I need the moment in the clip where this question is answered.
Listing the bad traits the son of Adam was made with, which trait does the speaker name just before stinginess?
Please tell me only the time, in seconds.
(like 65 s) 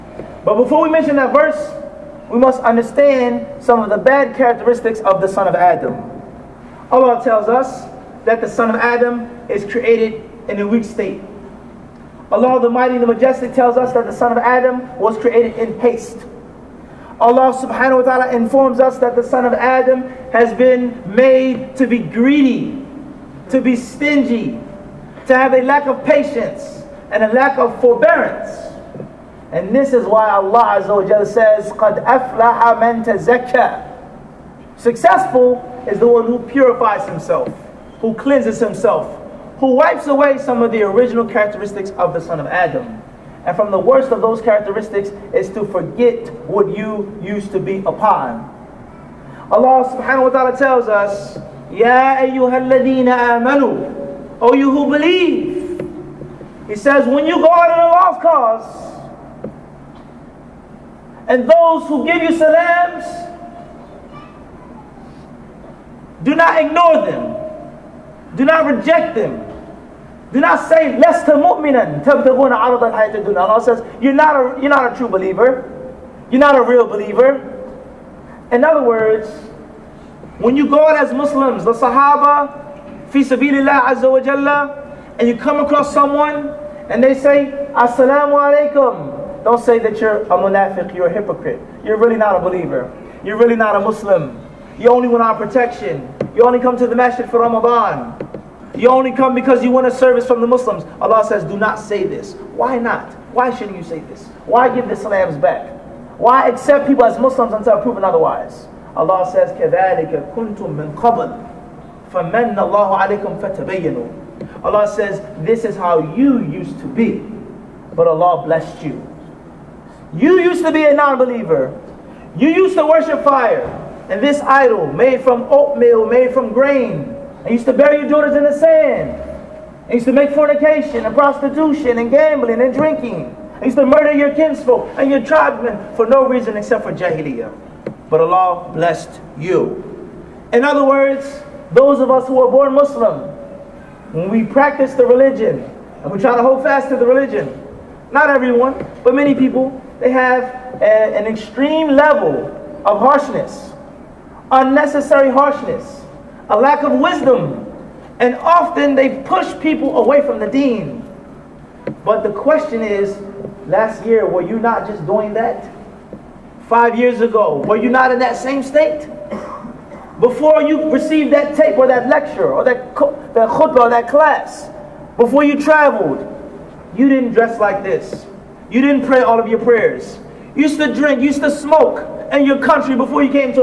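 21 s.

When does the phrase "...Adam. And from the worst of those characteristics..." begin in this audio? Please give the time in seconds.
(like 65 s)
42 s.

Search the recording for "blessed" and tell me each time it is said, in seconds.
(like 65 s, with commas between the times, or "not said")
118 s, 138 s.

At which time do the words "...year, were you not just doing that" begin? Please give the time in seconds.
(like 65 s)
164 s.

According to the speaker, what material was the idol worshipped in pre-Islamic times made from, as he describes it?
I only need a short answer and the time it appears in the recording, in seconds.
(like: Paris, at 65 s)
oatmeal, at 125 s.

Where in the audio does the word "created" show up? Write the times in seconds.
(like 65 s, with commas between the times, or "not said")
9 s, 15 s.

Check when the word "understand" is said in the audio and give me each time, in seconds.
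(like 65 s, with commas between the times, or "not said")
2 s.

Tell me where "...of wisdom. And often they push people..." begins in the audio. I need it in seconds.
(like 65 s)
156 s.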